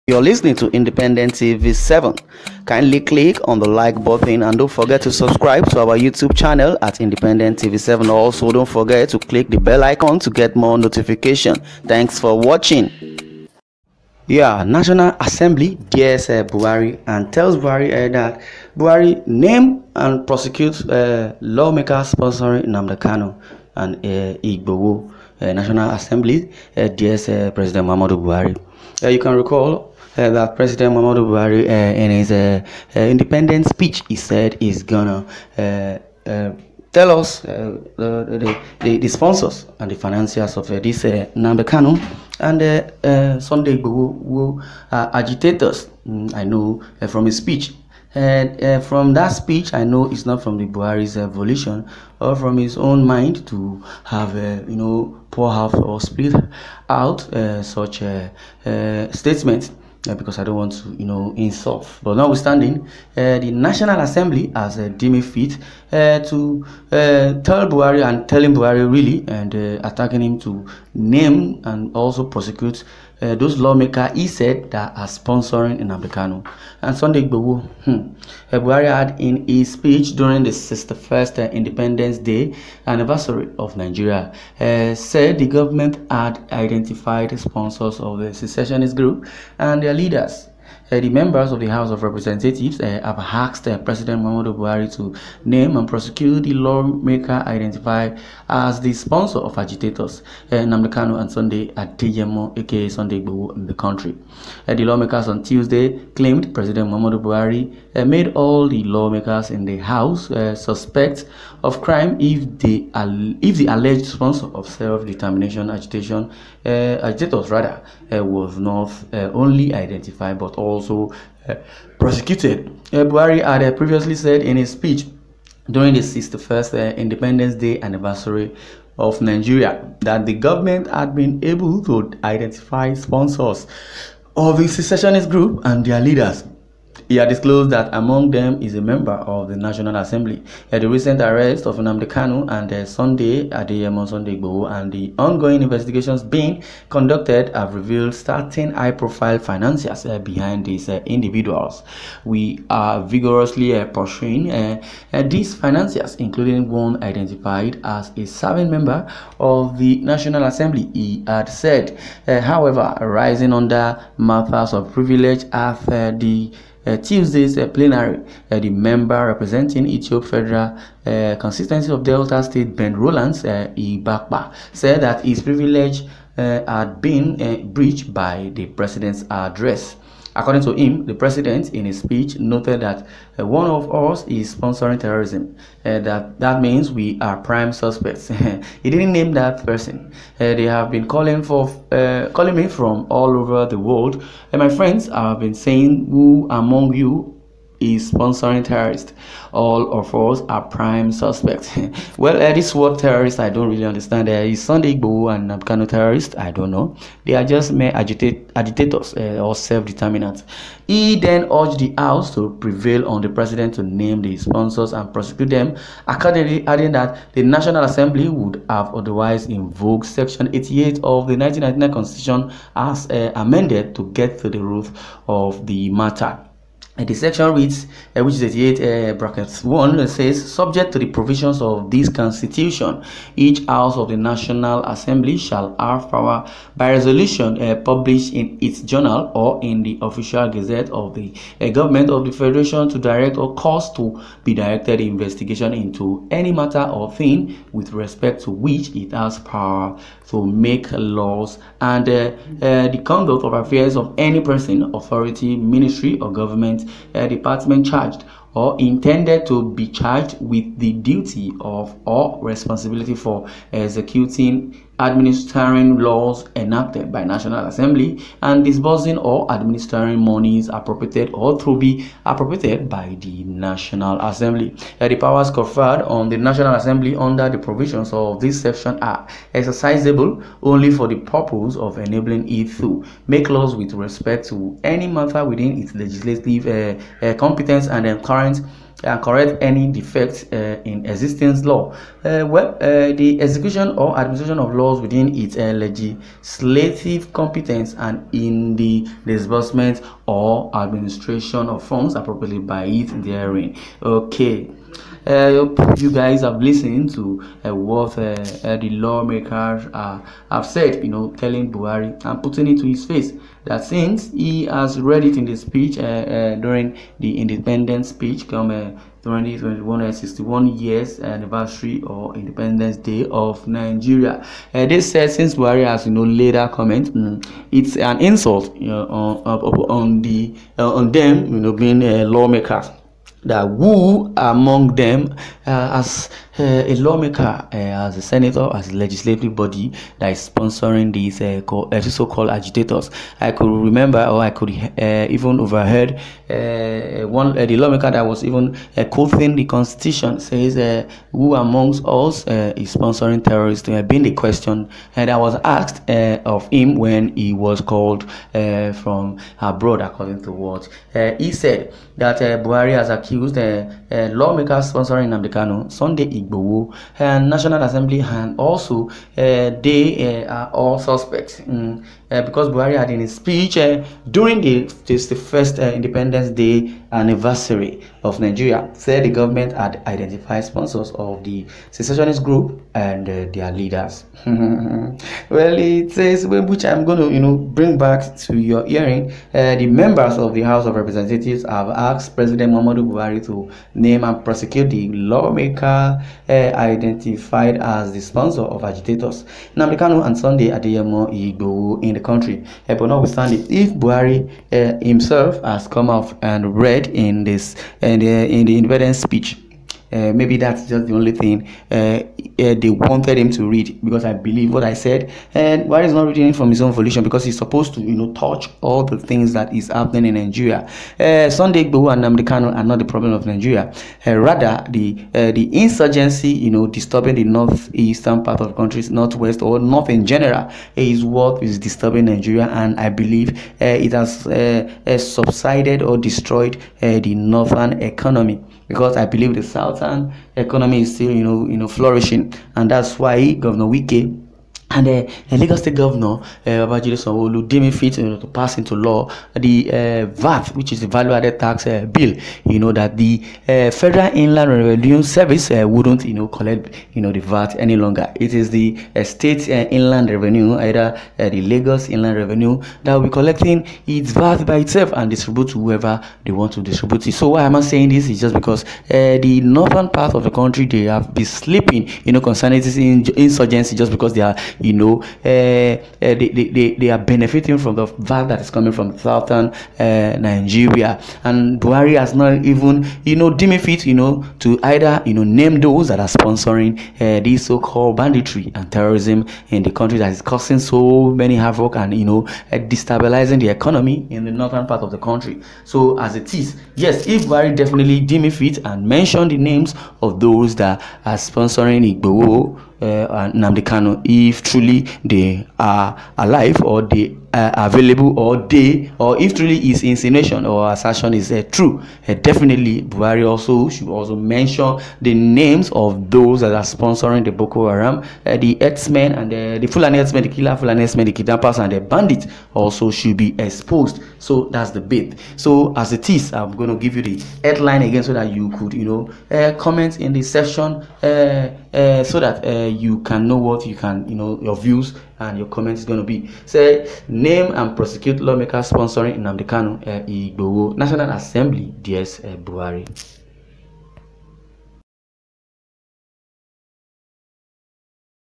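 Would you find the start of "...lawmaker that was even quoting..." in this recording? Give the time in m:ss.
5:47.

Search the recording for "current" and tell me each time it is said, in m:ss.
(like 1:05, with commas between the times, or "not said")
4:48.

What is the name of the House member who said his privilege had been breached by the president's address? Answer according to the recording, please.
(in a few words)
Ben Rollands Igbakpa.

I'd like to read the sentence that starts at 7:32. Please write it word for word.
You know that the uh, Federal Inland Revenue Service uh, wouldn't you know collect you know the VAT any longer.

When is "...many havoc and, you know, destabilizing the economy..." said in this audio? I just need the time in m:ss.
8:11.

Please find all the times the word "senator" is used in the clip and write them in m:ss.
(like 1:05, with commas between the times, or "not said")
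5:38.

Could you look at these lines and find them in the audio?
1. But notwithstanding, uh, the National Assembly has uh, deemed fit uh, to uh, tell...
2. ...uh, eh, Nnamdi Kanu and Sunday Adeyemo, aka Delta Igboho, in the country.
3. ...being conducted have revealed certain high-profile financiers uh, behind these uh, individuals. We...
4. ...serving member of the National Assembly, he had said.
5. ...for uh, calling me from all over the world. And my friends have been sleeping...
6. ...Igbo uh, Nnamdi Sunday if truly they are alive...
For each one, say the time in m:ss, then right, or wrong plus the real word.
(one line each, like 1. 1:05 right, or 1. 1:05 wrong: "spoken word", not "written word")
1. 1:02 right
2. 1:40 wrong: "Sunday", not "Delta"
3. 2:26 right
4. 2:38 right
5. 3:11 wrong: "saying", not "sleeping"
6. 8:22 wrong: "Kanu", not "Sunday".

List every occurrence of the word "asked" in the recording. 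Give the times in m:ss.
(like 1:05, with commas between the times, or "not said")
1:33, 5:55, 6:31.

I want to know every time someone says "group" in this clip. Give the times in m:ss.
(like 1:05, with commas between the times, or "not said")
1:28, 2:15, 6:22.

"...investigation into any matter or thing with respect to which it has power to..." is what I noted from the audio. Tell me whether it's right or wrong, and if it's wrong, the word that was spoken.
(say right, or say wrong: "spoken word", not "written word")
right.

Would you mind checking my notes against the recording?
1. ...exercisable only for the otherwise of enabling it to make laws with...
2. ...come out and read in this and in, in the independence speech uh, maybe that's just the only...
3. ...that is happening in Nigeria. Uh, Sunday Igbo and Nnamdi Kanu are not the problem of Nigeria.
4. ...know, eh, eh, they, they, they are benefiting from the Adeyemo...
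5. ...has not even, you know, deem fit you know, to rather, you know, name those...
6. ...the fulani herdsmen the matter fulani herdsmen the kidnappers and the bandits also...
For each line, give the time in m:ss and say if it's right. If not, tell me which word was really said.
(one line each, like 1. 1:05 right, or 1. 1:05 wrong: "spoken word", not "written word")
1. 4:39 wrong: "purpose", not "otherwise"
2. 6:45 right
3. 6:59 right
4. 7:54 wrong: "VAT", not "Adeyemo"
5. 8:02 wrong: "either", not "rather"
6. 8:39 wrong: "killer", not "matter".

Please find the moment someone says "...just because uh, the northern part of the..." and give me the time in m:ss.
7:48.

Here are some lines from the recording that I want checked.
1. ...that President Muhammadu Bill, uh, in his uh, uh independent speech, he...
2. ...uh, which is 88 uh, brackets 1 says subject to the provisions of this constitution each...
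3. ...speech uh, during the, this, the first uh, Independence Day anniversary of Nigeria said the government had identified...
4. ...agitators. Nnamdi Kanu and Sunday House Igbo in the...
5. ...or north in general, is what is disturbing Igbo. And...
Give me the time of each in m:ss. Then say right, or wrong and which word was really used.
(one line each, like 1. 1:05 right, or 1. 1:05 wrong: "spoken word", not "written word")
1. 0:30 wrong: "Buhari", not "Bill"
2. 3:48 right
3. 6:13 right
4. 6:38 wrong: "Adeyemo", not "House"
5. 7:09 wrong: "Nigeria", not "Igbo".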